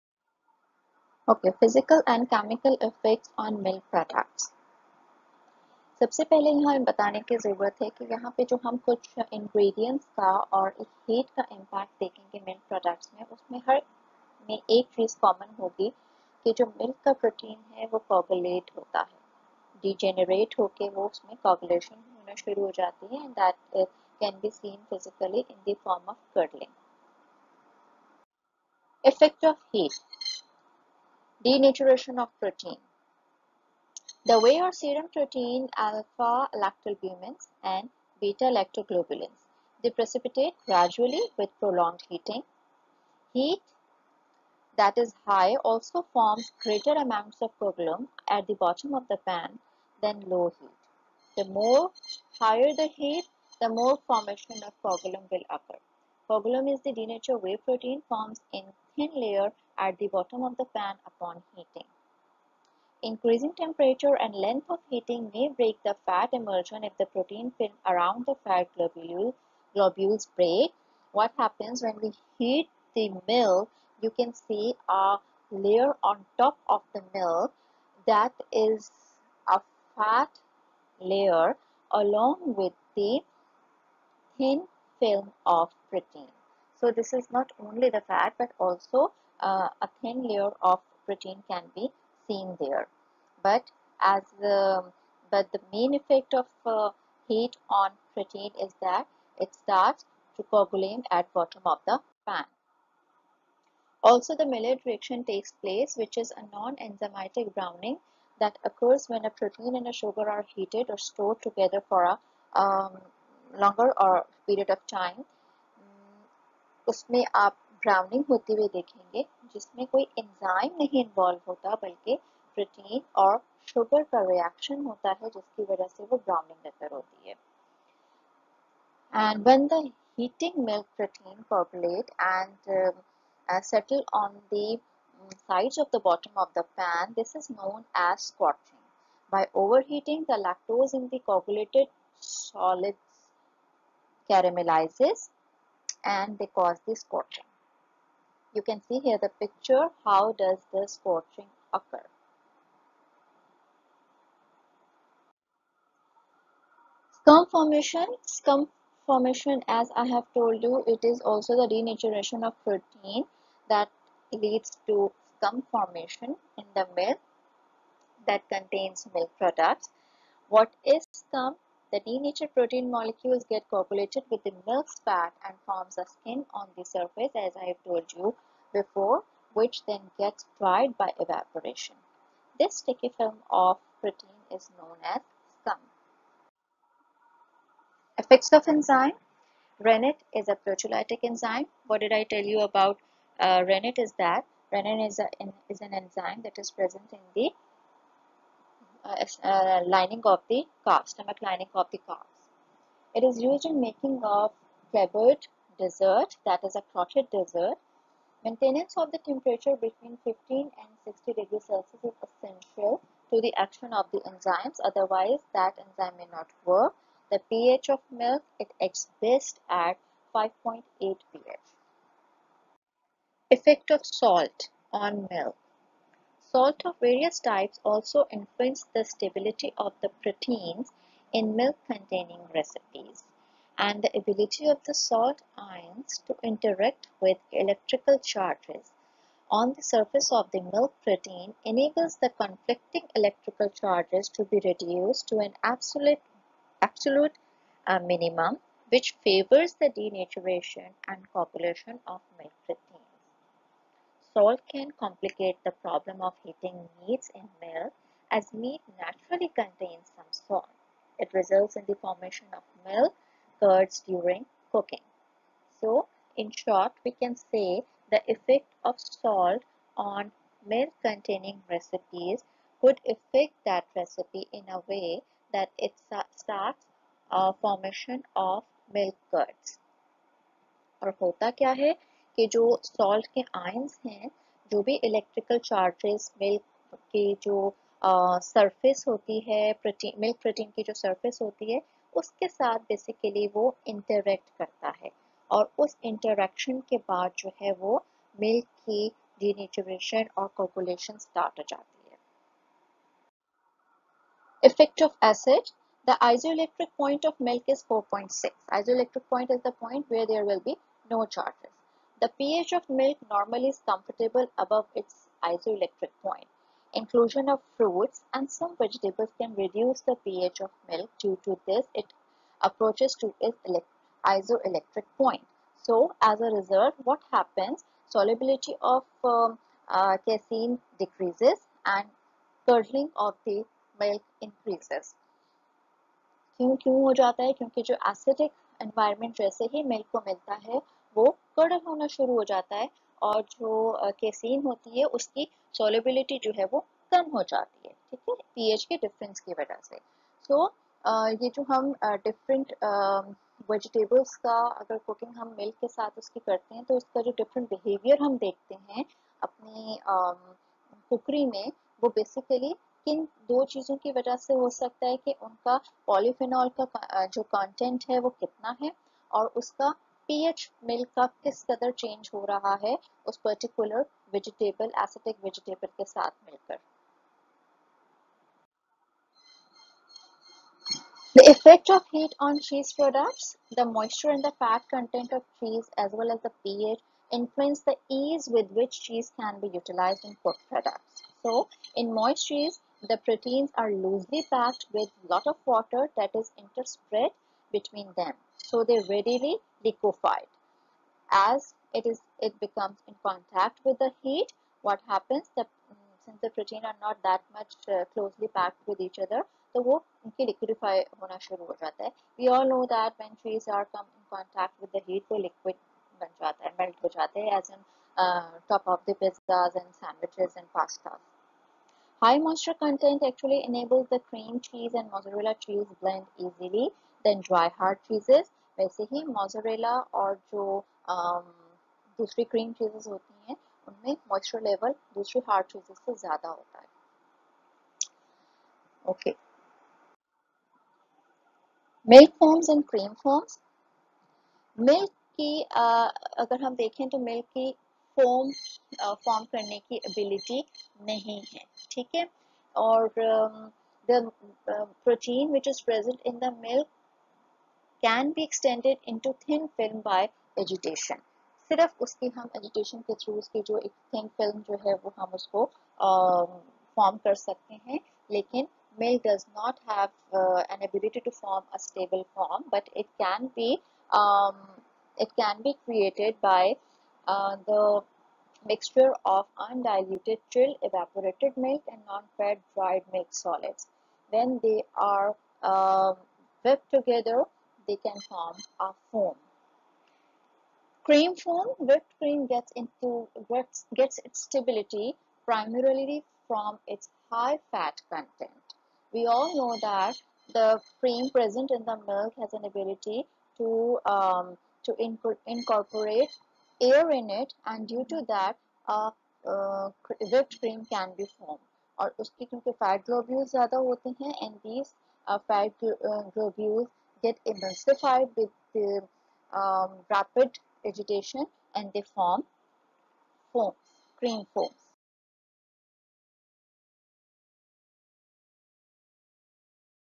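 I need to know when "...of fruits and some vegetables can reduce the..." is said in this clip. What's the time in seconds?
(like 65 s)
317 s.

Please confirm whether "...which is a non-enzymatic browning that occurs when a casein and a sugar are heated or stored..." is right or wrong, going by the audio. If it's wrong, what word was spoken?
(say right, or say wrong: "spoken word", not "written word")
wrong: "protein", not "casein".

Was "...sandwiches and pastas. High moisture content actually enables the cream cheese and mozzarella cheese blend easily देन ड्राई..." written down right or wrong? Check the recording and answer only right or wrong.
right.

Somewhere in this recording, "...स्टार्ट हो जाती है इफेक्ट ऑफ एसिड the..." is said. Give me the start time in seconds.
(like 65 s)
301 s.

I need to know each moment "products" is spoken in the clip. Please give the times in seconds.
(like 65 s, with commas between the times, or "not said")
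169 s, 382 s, 390 s.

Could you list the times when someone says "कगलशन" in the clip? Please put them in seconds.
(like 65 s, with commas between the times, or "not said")
21 s.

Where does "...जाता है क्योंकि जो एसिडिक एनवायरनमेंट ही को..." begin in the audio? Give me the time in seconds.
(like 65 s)
337 s.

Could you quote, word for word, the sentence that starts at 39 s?
They precipitate gradually with prolonged heating.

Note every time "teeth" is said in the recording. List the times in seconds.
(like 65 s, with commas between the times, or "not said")
not said.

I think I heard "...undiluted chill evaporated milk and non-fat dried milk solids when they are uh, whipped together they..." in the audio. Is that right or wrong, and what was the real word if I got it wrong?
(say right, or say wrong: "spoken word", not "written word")
right.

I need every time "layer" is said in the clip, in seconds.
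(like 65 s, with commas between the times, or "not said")
59 s, 75 s, 80 s, 90 s.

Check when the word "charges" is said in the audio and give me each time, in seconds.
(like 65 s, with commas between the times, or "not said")
238 s, 243 s, 311 s.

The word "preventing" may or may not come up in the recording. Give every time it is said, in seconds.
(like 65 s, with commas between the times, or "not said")
not said.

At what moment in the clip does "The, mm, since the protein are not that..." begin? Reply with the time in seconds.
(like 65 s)
405 s.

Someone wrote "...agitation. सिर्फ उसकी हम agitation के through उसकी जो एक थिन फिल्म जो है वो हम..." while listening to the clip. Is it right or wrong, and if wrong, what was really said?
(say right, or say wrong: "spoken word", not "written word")
right.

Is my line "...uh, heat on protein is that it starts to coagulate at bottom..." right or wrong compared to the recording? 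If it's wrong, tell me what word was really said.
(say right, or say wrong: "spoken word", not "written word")
right.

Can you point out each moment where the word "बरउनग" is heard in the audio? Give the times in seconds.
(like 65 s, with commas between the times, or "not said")
117 s, 126 s.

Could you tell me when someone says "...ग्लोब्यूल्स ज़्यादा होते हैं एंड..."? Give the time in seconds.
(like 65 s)
513 s.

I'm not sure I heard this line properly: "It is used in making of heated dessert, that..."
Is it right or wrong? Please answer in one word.
wrong.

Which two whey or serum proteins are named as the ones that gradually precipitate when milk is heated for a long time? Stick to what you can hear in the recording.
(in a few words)
alpha lactalbumins and beta lactoglobulins.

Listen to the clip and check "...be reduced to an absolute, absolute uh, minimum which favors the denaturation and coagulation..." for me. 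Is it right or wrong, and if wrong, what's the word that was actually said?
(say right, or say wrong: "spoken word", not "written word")
right.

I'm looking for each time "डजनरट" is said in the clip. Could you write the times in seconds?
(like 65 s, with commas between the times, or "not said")
19 s.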